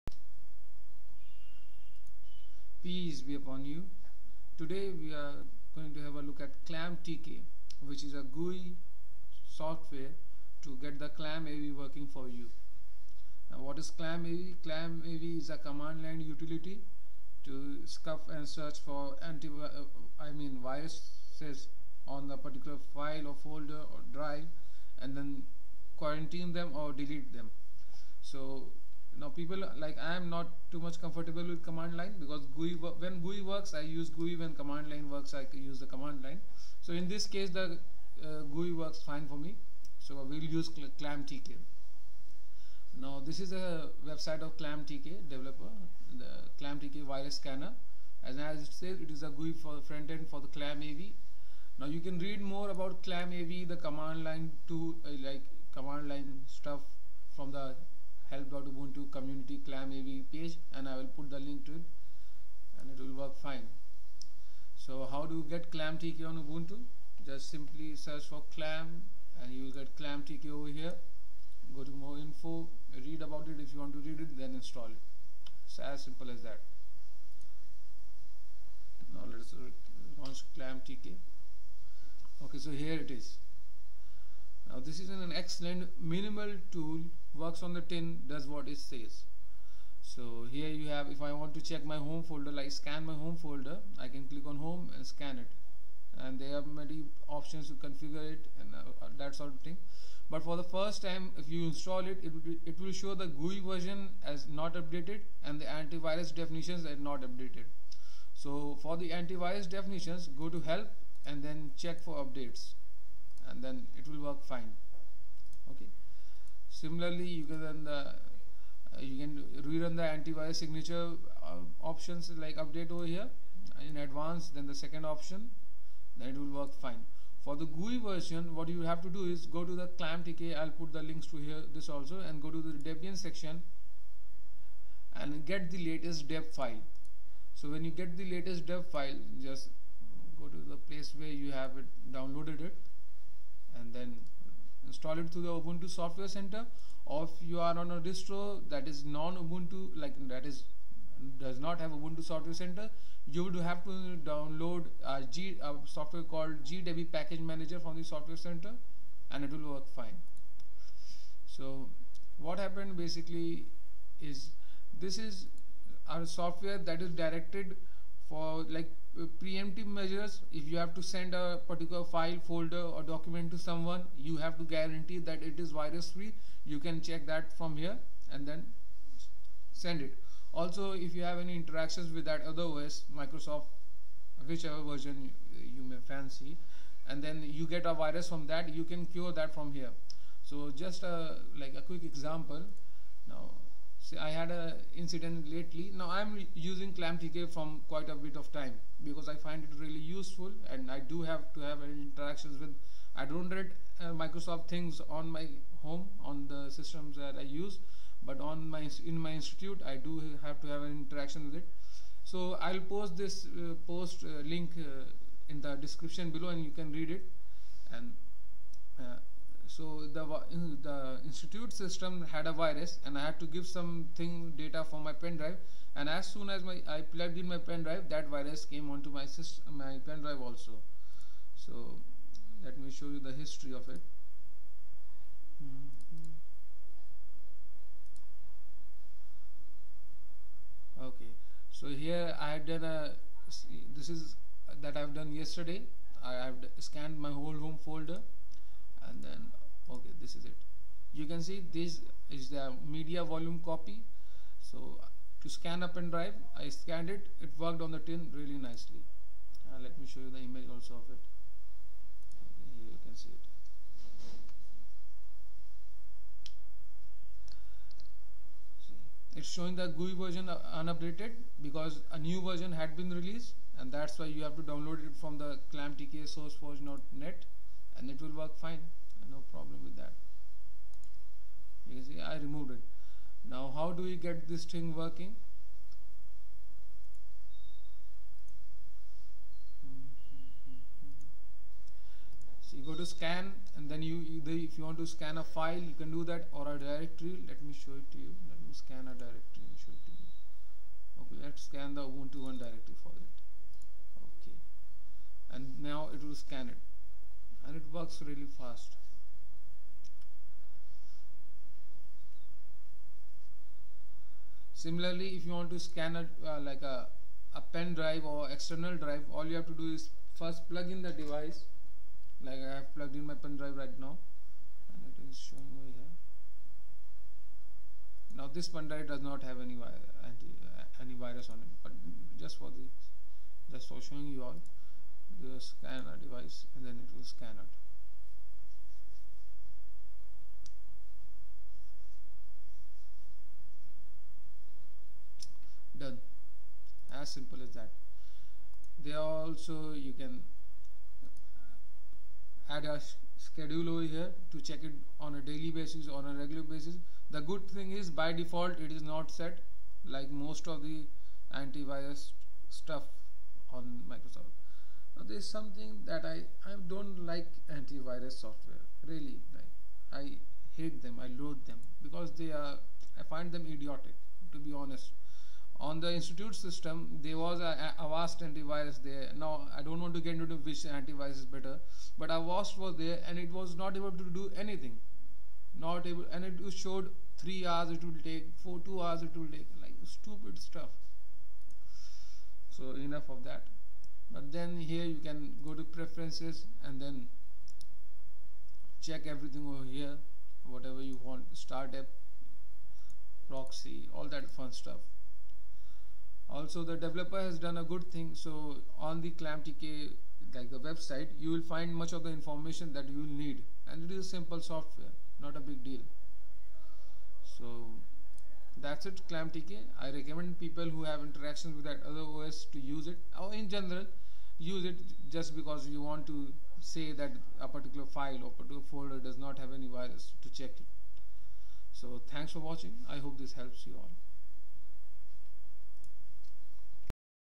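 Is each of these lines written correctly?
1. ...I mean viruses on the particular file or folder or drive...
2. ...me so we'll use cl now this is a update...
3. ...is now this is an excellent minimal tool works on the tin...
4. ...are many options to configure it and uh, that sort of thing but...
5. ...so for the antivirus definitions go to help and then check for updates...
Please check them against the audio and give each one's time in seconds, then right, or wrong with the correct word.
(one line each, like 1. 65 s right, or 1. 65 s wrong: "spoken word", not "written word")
1. 20 s right
2. 39 s wrong: "website", not "update"
3. 83 s right
4. 96 s right
5. 108 s right.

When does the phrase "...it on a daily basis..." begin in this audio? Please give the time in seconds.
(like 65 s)
354 s.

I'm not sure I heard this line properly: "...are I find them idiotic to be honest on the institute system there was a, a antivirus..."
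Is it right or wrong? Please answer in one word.
right.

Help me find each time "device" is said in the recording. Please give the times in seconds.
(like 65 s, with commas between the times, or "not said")
321 s, 336 s.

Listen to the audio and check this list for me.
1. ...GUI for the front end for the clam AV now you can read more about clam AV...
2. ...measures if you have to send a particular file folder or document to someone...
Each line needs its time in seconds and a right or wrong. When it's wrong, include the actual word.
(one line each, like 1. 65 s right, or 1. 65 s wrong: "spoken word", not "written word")
1. 49 s right
2. 169 s right.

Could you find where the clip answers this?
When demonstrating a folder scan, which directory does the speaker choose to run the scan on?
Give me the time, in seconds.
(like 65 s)
302 s.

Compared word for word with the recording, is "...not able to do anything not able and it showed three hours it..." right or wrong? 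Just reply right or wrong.
right.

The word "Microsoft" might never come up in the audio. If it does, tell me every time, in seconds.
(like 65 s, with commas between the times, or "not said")
183 s, 204 s, 364 s.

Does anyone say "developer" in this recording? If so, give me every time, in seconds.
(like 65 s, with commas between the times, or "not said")
45 s, 407 s.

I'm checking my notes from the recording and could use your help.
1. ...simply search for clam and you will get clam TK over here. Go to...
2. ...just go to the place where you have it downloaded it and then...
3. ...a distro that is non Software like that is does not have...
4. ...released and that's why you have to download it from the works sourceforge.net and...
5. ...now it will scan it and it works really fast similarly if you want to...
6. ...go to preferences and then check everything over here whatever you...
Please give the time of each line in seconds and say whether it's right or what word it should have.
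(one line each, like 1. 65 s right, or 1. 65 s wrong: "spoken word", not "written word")
1. 67 s right
2. 139 s right
3. 147 s wrong: "Ubuntu", not "Software"
4. 273 s wrong: "clamtks", not "works"
5. 305 s right
6. 395 s right.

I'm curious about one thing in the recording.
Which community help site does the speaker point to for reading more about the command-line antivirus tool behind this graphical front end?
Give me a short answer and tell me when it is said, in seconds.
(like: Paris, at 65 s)
help.ubuntu community, at 58 s.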